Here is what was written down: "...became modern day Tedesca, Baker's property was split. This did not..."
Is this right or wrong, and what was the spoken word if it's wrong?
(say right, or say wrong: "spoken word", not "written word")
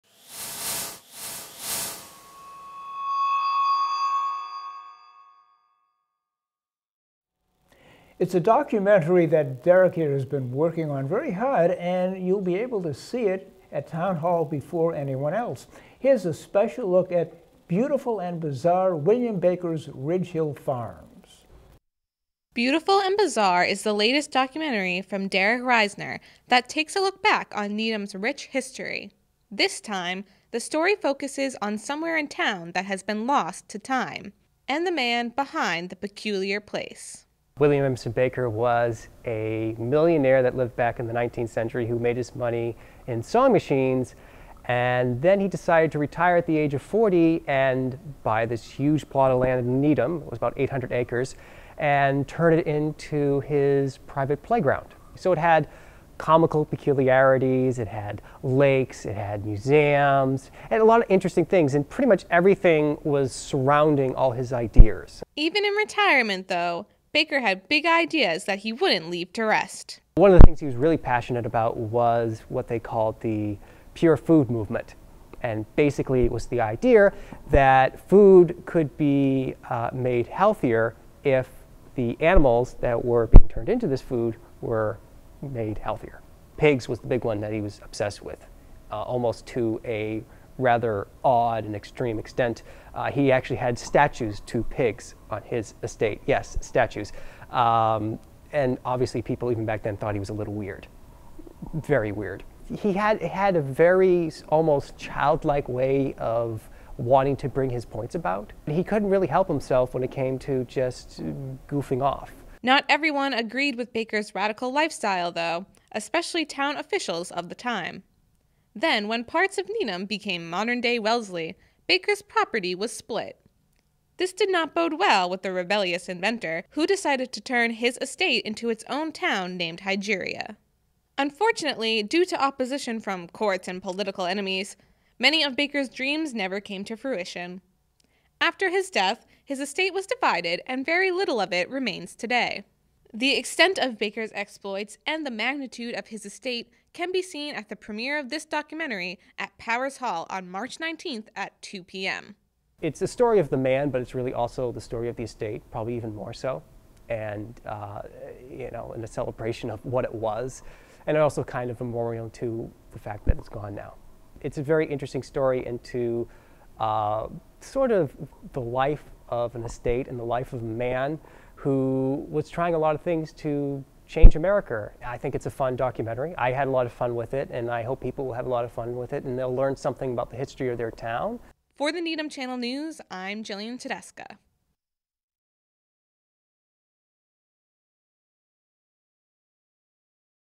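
wrong: "Wellesley", not "Tedesca".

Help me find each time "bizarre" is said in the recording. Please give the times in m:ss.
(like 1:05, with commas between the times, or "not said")
0:18, 0:23.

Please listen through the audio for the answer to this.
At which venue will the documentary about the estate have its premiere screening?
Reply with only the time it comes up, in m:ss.
2:29.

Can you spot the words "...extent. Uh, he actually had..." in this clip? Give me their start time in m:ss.
1:32.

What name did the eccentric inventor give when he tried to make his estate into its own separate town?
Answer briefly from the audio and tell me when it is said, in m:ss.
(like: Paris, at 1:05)
Hygeria, at 2:09.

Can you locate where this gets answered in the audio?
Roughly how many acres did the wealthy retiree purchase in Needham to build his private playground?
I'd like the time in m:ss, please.
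0:50.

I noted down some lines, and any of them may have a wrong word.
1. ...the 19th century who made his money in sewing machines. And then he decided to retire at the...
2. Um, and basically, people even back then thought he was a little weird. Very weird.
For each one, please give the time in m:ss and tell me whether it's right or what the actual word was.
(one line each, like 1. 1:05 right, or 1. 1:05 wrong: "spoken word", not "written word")
1. 0:41 right
2. 1:37 wrong: "obviously", not "basically".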